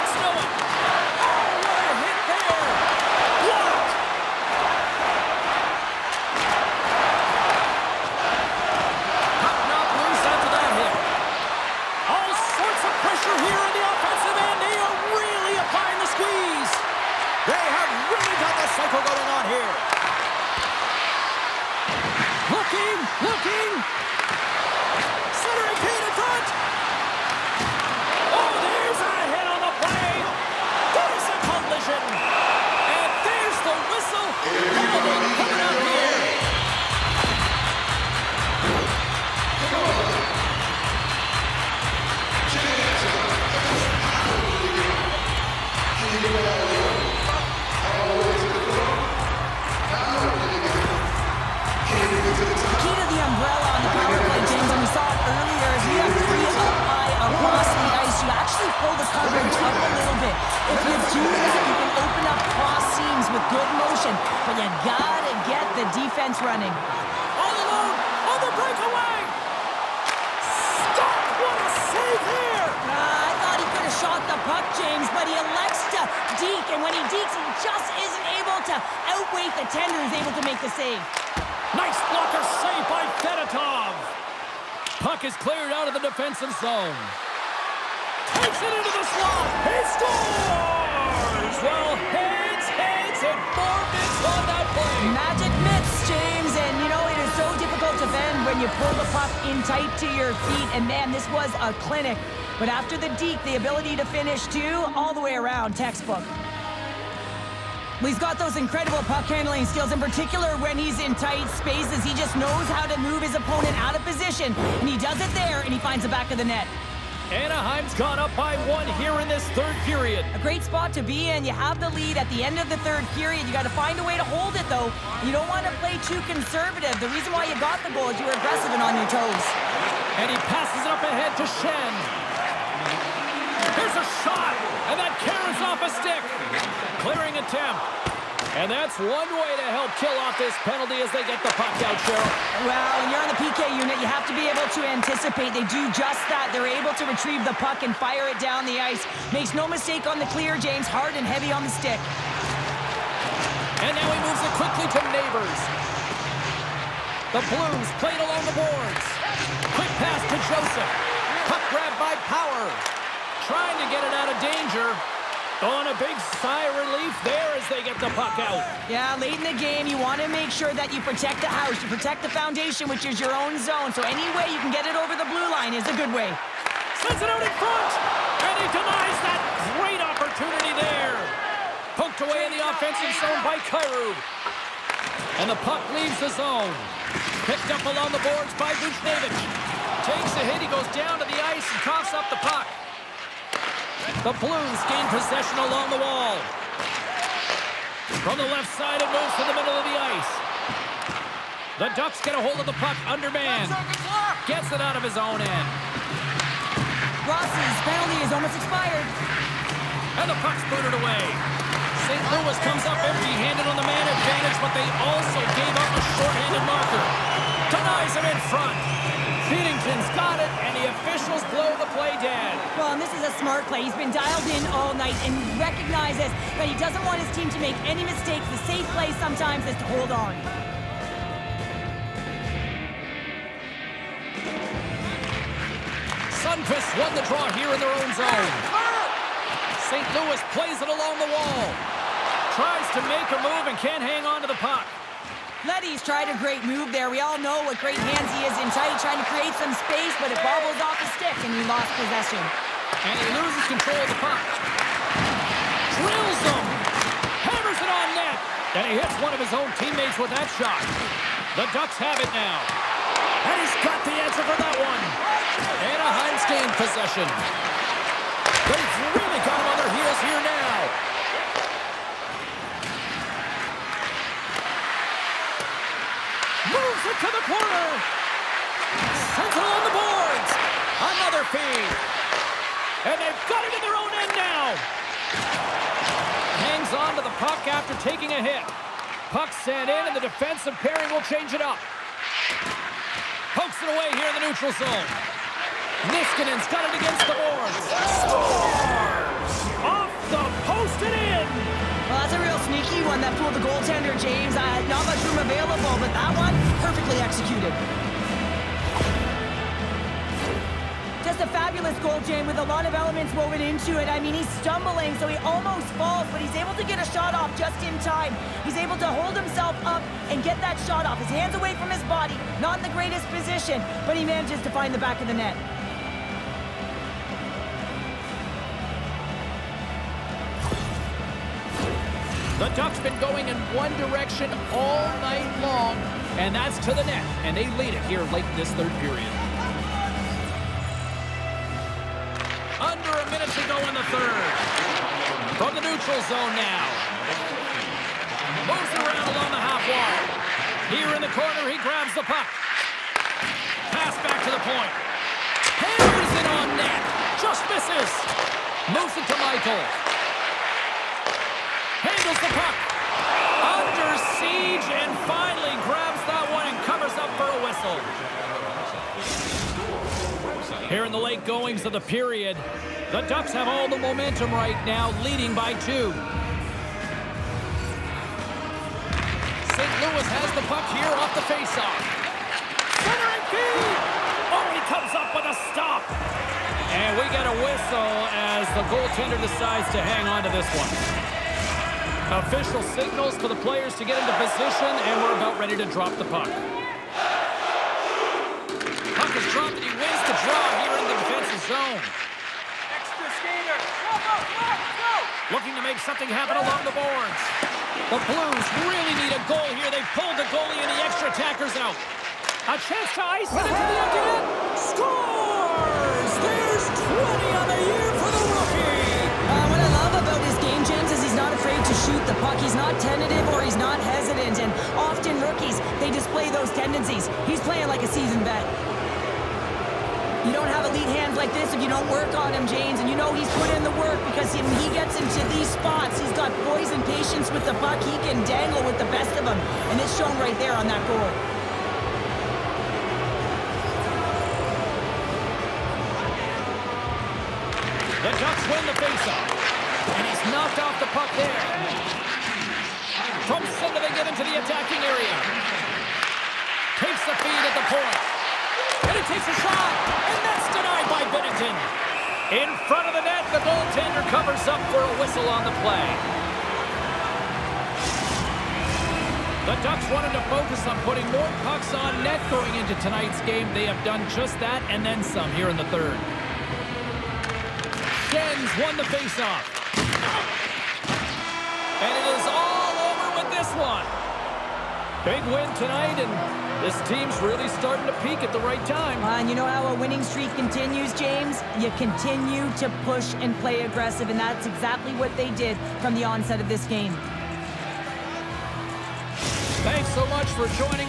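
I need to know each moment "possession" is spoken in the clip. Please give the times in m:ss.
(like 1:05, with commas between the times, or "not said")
3:15, 4:11, 4:26.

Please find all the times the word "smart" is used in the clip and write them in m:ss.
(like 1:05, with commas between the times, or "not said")
3:43.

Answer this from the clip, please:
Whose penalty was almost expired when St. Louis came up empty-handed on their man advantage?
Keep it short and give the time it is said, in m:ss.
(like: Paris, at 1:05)
Ross, at 3:27.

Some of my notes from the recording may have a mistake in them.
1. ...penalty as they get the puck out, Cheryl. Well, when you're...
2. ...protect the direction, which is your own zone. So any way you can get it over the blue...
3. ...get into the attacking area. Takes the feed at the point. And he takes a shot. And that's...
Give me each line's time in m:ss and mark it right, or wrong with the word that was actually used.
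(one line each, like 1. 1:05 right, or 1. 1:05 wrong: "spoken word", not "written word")
1. 2:20 right
2. 2:51 wrong: "foundation", not "direction"
3. 7:34 right.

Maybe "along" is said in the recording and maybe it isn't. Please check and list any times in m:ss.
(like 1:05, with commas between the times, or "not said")
2:38, 3:07, 3:15, 4:00, 5:49, 6:46.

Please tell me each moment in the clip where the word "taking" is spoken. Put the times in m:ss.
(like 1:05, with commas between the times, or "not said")
4:48.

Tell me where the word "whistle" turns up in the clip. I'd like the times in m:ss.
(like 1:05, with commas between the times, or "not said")
6:07, 6:27, 7:45.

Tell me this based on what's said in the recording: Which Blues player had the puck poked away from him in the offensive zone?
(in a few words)
Kyrou.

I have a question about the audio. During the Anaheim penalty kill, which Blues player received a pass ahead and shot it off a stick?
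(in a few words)
Schenn.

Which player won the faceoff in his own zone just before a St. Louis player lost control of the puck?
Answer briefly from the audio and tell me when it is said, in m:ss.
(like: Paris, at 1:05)
Sundqvist, at 3:56.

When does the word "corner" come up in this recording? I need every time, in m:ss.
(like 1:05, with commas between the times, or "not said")
4:37, 5:51.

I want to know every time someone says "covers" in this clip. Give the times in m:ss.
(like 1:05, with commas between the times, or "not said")
6:06, 7:44.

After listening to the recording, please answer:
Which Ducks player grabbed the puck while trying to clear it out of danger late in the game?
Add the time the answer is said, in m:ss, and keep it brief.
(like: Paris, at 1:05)
Power, at 2:42.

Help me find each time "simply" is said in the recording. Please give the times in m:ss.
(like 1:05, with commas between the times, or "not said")
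not said.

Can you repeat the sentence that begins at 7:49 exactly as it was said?
The Ducks wanted to focus on putting more pucks on net going into tonight's game.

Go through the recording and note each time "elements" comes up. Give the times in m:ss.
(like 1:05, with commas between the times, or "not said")
5:12.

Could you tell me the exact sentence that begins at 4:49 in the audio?
Puck sent in, and the defensive pairing will change it up.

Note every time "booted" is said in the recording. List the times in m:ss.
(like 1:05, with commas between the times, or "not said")
3:30.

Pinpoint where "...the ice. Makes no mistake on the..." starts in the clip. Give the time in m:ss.
2:28.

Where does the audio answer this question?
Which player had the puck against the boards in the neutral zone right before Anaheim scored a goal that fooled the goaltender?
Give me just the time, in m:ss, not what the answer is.
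4:56.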